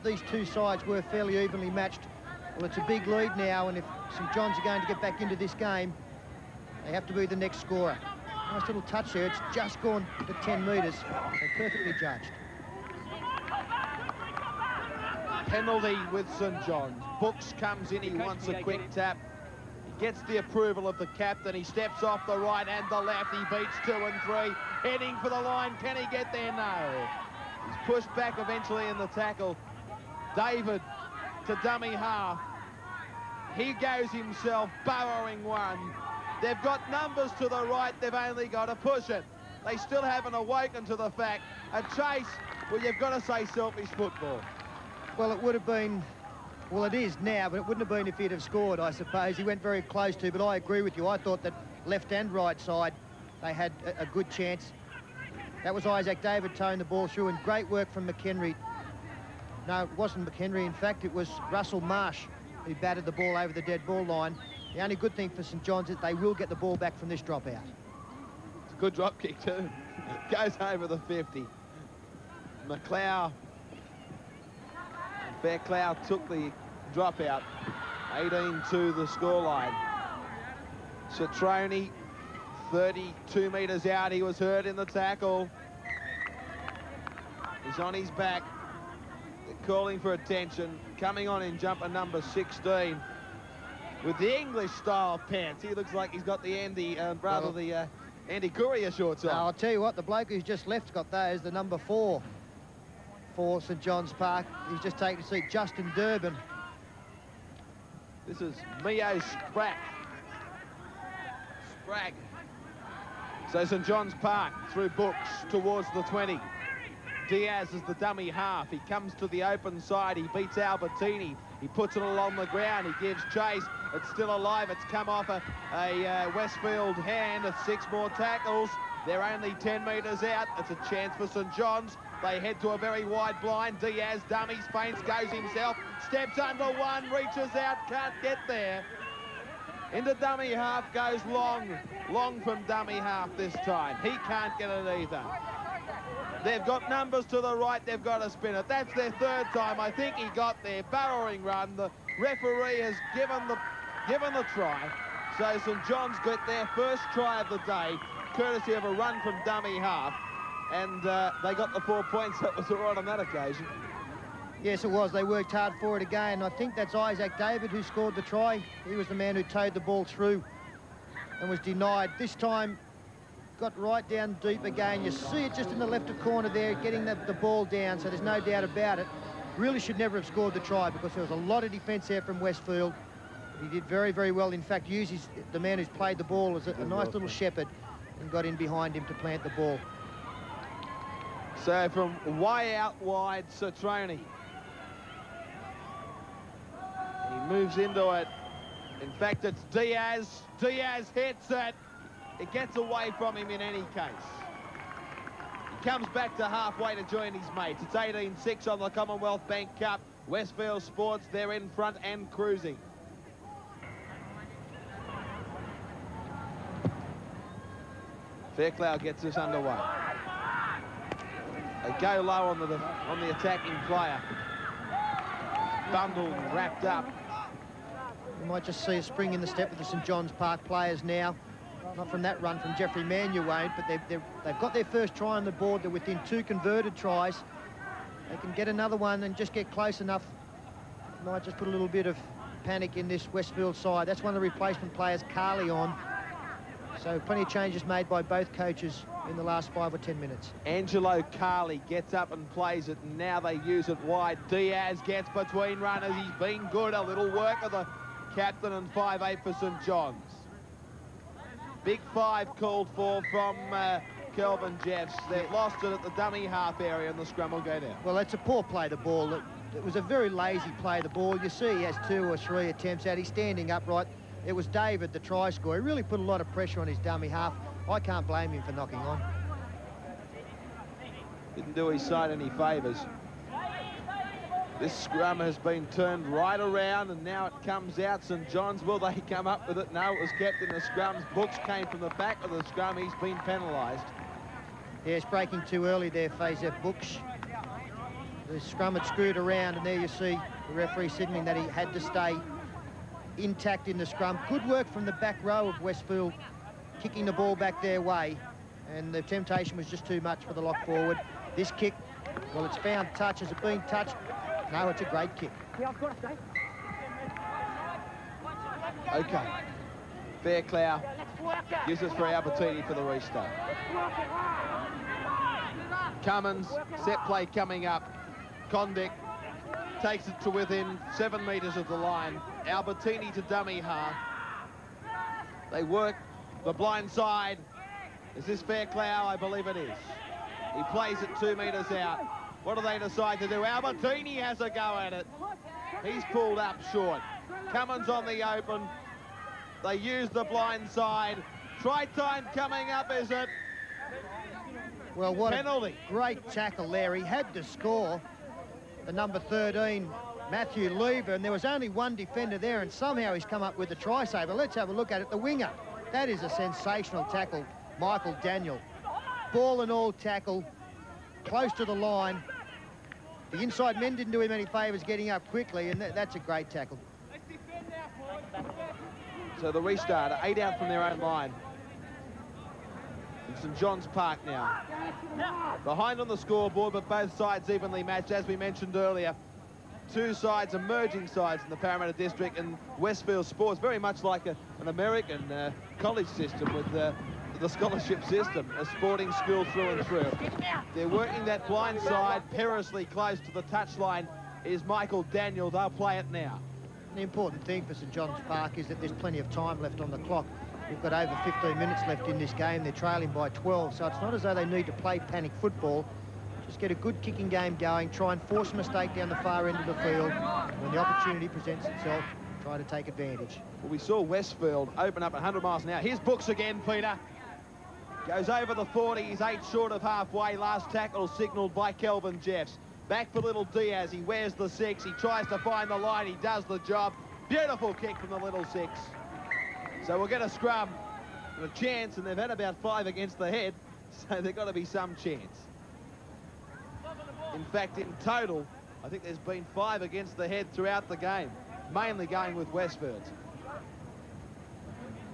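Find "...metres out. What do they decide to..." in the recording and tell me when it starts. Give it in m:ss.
5:41.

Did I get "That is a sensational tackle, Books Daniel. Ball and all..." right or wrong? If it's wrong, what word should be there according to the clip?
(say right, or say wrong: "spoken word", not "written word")
wrong: "Michael", not "Books".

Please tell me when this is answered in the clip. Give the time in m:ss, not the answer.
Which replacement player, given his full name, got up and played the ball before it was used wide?
4:10.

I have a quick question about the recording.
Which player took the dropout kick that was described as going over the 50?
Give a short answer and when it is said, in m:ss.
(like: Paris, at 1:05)
McLeod Becklau, at 1:12.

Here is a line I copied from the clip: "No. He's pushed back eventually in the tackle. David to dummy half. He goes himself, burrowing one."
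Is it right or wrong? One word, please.
right.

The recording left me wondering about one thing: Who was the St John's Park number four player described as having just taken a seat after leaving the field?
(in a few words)
Justin Durbin.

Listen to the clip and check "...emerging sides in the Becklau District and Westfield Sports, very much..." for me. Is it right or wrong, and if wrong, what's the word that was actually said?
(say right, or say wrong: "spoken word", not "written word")
wrong: "Parramatta", not "Becklau".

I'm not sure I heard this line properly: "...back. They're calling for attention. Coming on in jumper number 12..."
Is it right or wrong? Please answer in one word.
wrong.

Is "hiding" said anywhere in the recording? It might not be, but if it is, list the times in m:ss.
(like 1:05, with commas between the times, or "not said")
not said.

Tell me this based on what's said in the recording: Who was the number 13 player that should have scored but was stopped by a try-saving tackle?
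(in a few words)
Matthew Lever.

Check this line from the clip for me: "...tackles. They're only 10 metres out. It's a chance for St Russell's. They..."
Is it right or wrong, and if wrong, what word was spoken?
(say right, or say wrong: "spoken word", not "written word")
wrong: "John", not "Russell".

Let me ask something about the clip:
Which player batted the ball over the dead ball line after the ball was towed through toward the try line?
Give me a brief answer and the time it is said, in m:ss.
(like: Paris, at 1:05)
Russell Marsh, at 1:01.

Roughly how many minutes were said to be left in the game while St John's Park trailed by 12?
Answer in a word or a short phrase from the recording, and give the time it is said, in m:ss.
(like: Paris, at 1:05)
15, at 6:51.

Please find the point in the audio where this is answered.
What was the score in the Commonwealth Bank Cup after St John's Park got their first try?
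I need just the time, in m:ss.
3:27.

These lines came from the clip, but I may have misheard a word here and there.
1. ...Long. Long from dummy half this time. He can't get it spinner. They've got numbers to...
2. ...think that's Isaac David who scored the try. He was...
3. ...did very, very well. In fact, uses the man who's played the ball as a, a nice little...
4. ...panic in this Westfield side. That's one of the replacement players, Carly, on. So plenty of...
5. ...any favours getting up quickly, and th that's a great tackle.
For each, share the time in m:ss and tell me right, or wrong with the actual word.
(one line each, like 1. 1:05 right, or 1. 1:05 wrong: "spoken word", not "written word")
1. 2:21 wrong: "either", not "spinner"
2. 2:46 right
3. 3:03 right
4. 4:02 right
5. 6:14 right.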